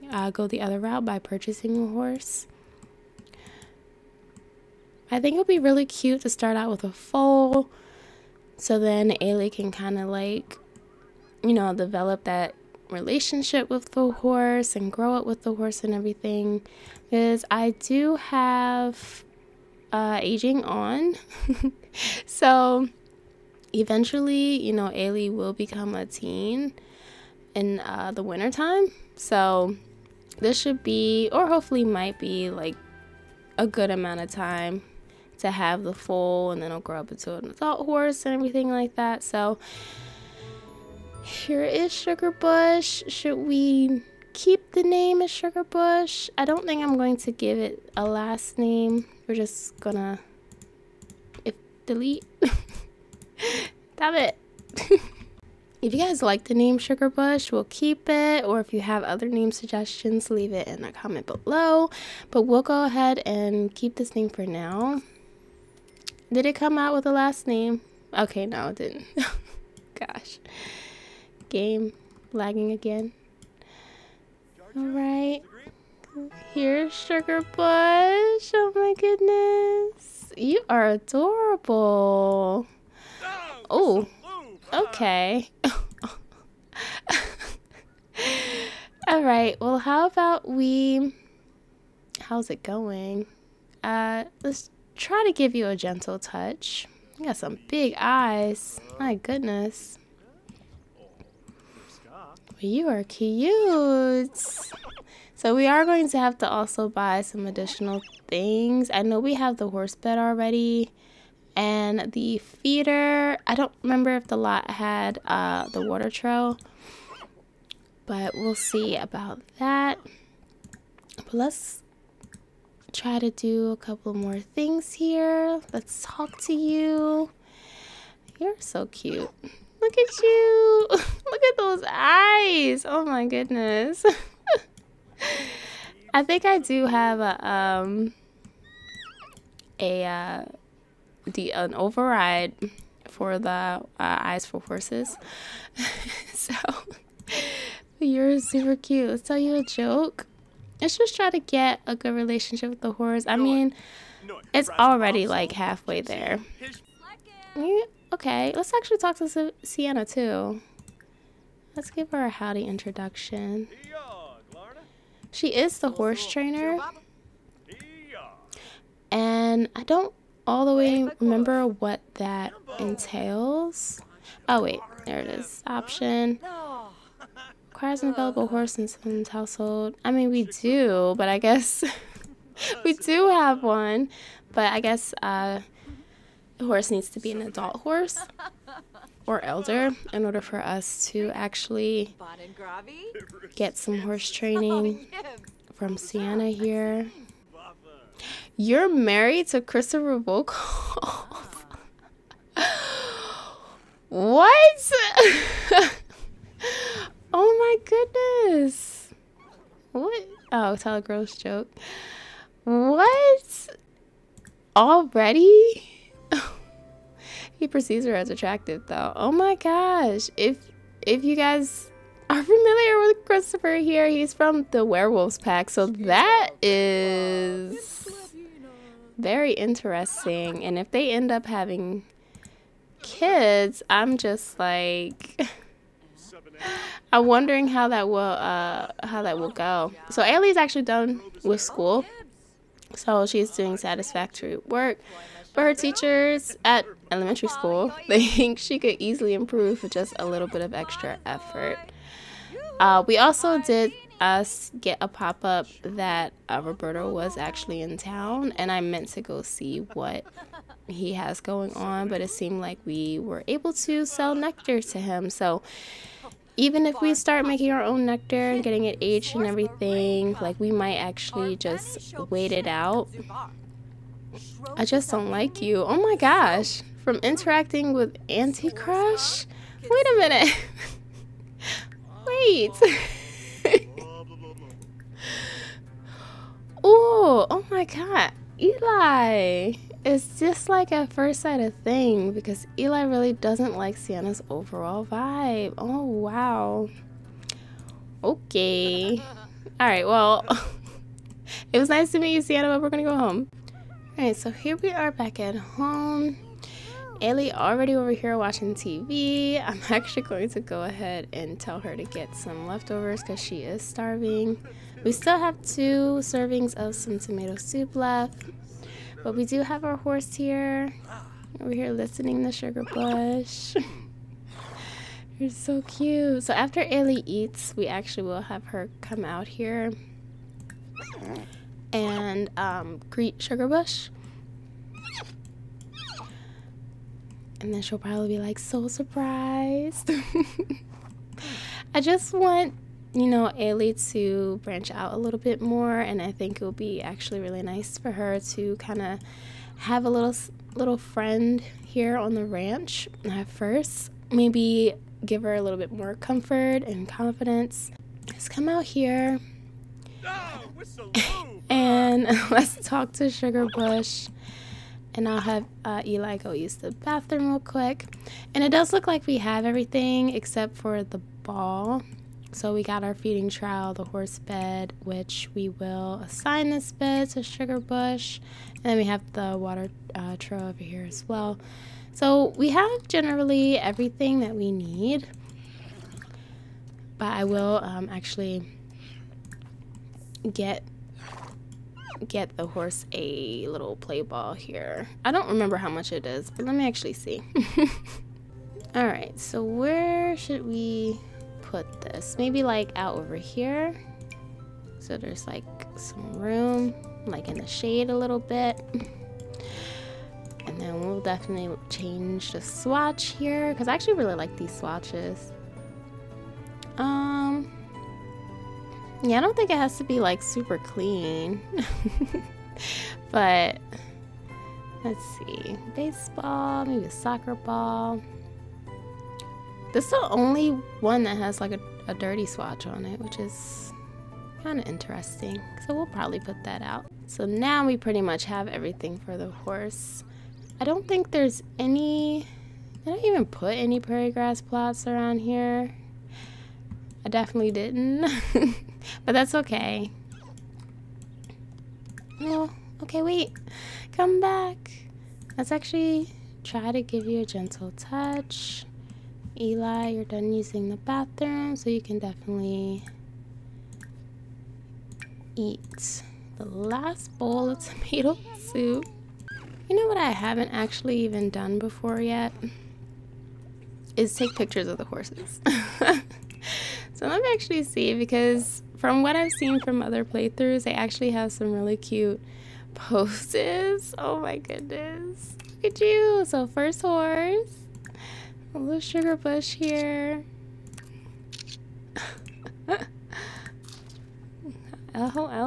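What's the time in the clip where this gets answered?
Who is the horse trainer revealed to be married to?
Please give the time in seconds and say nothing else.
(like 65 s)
199 s.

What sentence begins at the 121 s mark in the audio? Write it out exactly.
But let's try to do a couple more things here.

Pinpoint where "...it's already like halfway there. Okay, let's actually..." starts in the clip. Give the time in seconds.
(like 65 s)
154 s.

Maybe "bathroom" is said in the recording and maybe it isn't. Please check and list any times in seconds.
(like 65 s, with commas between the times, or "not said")
366 s, 460 s.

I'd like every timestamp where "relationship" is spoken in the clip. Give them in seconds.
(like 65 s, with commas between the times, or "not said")
12 s, 152 s.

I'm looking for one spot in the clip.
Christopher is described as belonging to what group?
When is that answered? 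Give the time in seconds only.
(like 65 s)
224 s.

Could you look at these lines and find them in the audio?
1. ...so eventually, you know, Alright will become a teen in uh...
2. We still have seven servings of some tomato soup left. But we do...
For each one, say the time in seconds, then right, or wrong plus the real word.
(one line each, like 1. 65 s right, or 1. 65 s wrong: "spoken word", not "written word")
1. 22 s wrong: "Ailey", not "Alright"
2. 315 s wrong: "two", not "seven".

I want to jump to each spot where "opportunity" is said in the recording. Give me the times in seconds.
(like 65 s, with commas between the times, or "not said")
not said.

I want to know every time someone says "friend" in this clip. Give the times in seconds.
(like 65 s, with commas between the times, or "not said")
350 s.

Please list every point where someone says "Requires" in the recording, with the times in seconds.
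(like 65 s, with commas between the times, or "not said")
177 s.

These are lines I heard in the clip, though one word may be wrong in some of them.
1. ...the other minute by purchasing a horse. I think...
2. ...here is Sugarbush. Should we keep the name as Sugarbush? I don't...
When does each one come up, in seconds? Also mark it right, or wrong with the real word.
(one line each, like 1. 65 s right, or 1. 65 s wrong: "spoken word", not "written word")
1. 0 s wrong: "route", not "minute"
2. 41 s right.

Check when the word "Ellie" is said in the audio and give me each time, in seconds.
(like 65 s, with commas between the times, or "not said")
307 s, 326 s.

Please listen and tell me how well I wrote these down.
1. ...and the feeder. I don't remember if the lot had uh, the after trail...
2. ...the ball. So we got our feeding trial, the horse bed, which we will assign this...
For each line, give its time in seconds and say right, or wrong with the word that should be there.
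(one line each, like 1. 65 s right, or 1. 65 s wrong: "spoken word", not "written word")
1. 111 s wrong: "water", not "after"
2. 371 s right.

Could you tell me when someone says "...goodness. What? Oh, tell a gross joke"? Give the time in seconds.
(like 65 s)
207 s.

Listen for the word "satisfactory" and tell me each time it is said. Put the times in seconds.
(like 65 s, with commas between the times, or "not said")
243 s.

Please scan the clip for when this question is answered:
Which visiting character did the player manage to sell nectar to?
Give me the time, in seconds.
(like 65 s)
256 s.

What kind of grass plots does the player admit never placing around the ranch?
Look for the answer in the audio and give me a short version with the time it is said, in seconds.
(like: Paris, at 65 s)
prairie grass, at 443 s.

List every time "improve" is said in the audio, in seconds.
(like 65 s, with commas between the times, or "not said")
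249 s.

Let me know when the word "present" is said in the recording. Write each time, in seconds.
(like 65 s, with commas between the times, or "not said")
not said.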